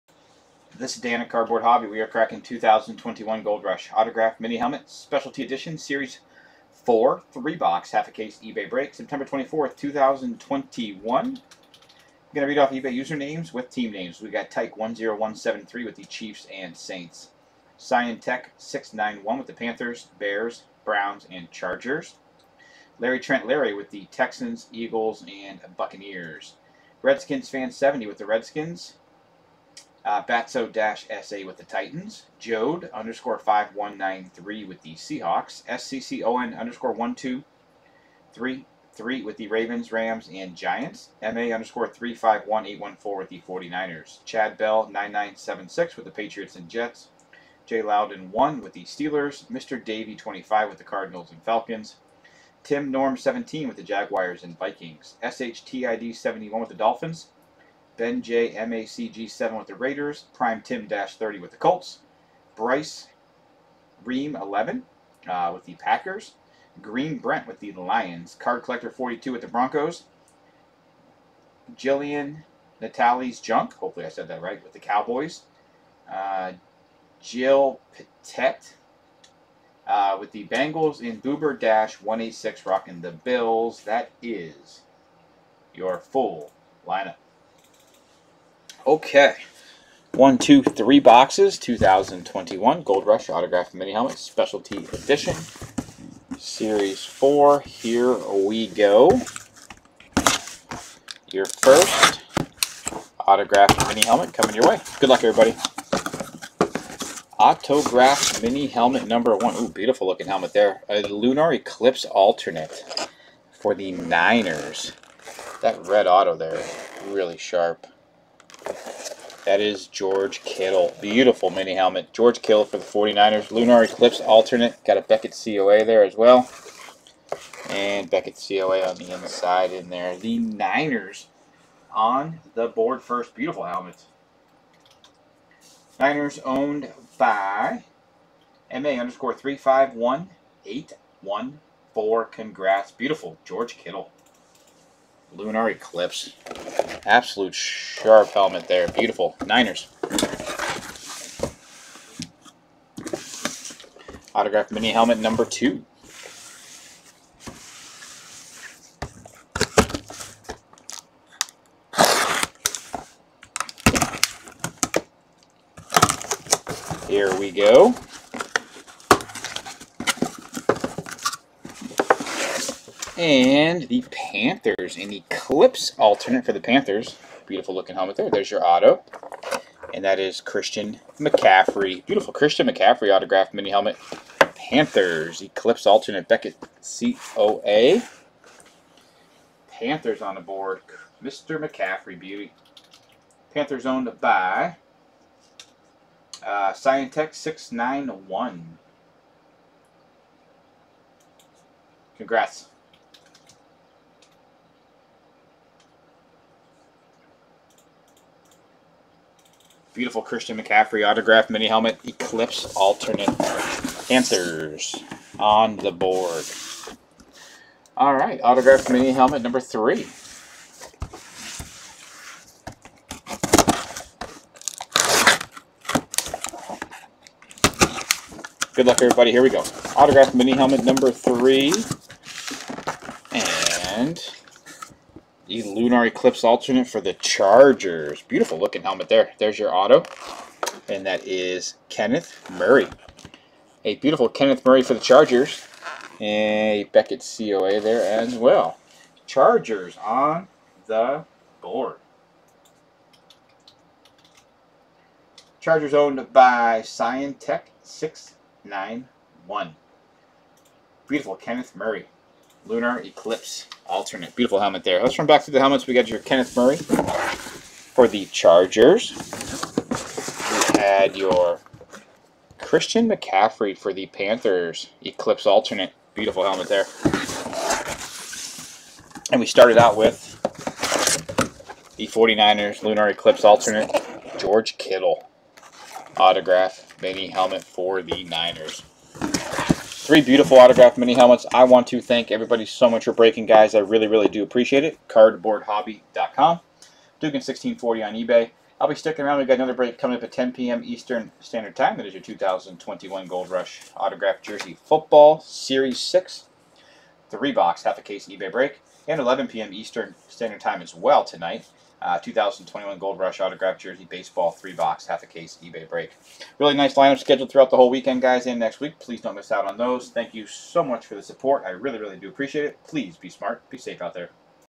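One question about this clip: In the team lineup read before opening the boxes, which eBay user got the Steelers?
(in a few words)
Jay Loudon 1.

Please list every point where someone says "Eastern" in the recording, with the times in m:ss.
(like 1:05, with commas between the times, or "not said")
5:00, 5:09.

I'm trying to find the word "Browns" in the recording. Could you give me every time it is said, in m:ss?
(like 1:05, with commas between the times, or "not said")
0:20.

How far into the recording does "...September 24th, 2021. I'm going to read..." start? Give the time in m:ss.
0:08.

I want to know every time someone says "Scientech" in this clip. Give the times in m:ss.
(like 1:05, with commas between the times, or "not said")
3:16, 4:16.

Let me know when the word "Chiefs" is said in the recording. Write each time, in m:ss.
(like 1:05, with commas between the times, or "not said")
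0:16.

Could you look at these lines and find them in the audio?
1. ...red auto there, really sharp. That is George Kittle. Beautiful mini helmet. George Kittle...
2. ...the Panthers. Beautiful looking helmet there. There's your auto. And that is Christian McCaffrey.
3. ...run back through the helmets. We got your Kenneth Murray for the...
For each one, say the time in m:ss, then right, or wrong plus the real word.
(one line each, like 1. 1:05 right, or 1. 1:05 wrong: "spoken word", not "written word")
1. 1:55 right
2. 2:56 right
3. 4:25 right.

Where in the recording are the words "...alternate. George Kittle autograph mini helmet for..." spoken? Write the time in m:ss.
4:43.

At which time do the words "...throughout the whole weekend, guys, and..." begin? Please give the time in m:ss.
5:17.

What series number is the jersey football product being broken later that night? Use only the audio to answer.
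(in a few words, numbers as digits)
6.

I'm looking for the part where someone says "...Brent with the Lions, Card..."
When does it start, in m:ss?
1:07.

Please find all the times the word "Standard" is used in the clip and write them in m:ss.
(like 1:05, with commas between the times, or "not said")
5:01, 5:10.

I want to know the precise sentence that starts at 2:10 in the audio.
The Niners on the board first.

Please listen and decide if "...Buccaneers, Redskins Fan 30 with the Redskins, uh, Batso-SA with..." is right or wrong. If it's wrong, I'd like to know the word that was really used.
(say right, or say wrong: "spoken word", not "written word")
wrong: "70", not "30".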